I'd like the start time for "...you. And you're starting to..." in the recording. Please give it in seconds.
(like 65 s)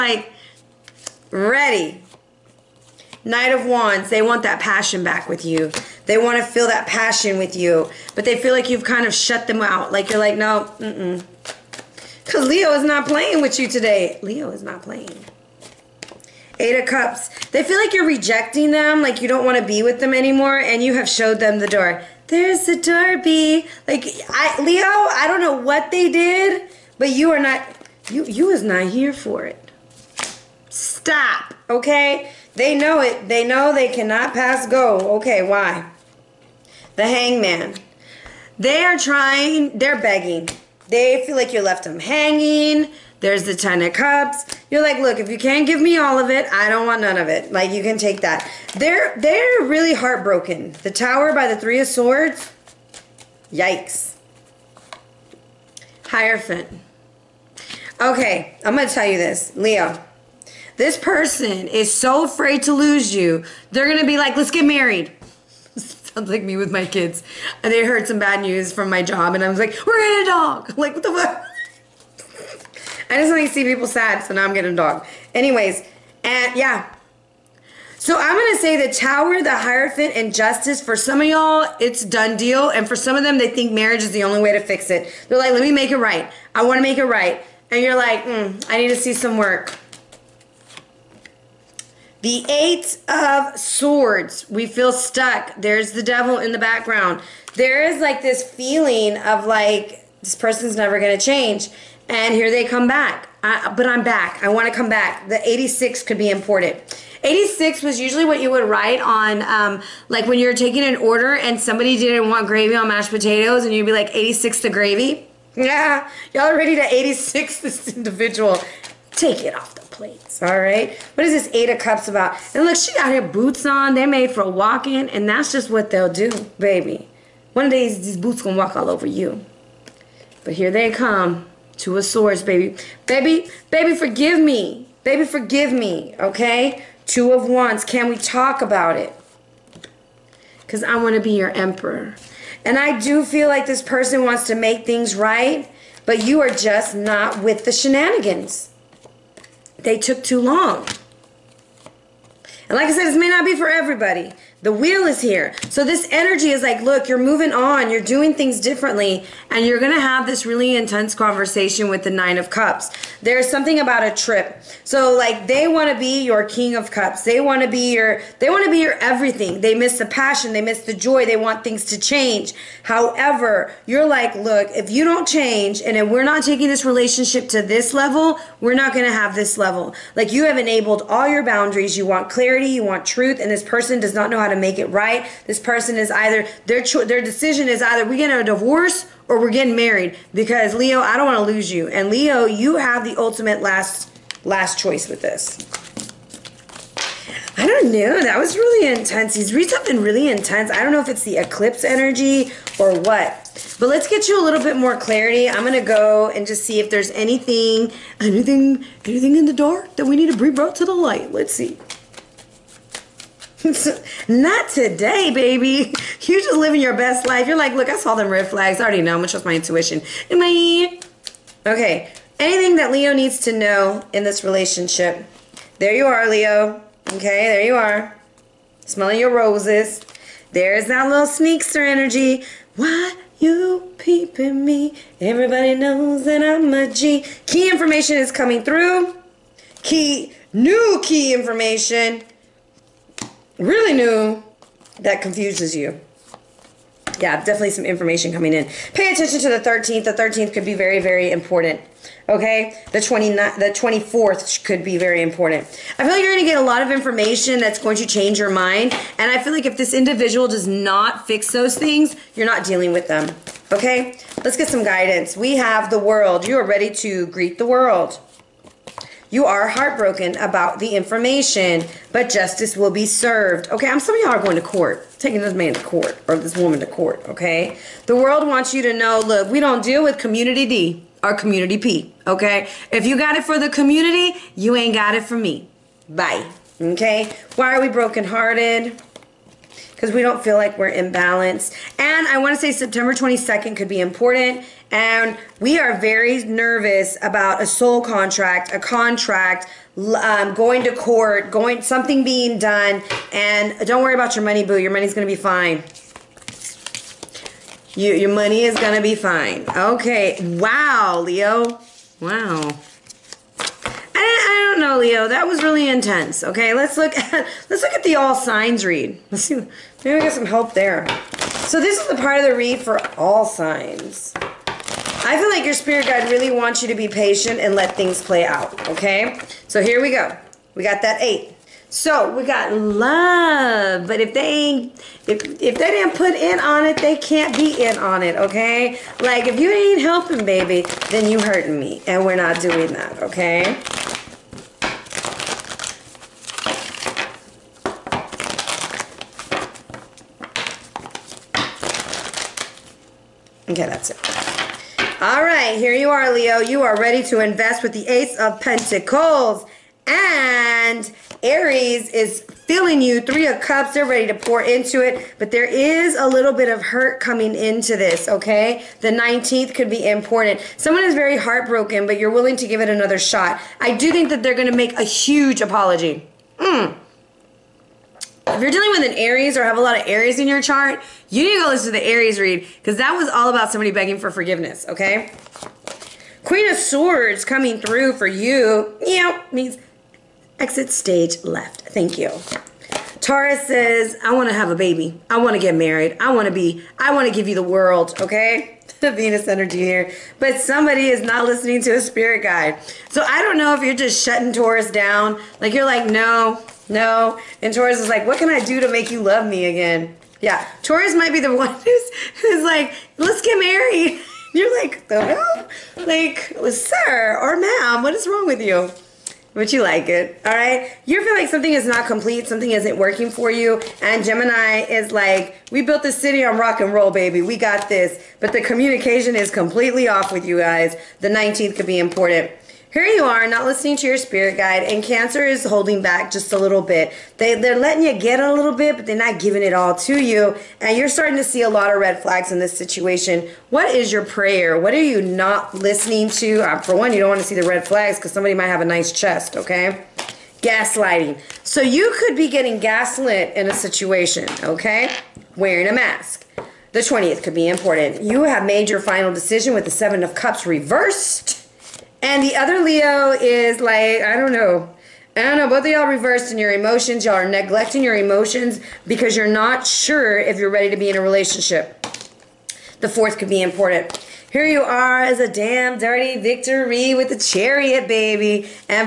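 440 s.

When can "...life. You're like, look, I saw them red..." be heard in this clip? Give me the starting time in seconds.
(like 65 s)
217 s.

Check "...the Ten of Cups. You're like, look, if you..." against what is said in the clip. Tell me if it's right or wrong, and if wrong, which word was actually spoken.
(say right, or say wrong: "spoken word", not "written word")
right.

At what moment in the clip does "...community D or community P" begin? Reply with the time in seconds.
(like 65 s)
280 s.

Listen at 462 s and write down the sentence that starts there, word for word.
And the other Leo is like, I don't know.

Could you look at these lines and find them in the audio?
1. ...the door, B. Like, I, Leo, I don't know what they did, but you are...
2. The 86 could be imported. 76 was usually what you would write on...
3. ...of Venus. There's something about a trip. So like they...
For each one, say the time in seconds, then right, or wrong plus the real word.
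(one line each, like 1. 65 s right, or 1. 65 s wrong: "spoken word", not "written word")
1. 22 s right
2. 105 s wrong: "86", not "76"
3. 162 s wrong: "Cups", not "Venus".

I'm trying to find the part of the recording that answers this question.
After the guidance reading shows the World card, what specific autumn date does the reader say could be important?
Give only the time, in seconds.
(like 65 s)
292 s.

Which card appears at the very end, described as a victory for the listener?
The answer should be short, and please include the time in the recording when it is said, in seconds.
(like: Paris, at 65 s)
The Chariot, at 477 s.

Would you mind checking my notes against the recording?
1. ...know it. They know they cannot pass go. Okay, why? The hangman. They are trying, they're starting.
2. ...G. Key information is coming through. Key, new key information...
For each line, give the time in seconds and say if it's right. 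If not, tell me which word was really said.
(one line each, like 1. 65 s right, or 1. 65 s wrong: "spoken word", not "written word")
1. 32 s wrong: "begging", not "starting"
2. 236 s right.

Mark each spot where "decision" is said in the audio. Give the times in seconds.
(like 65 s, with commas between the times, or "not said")
187 s, 459 s.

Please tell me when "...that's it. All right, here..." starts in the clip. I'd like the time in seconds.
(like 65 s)
353 s.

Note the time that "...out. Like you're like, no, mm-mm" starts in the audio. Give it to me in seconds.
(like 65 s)
9 s.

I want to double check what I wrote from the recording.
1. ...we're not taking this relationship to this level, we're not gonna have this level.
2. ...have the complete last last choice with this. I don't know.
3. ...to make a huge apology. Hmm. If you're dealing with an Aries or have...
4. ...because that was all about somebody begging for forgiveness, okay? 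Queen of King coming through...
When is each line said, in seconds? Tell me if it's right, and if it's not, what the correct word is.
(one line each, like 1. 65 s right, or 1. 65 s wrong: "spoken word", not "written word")
1. 176 s right
2. 192 s wrong: "ultimate", not "complete"
3. 374 s right
4. 382 s wrong: "Swords", not "King".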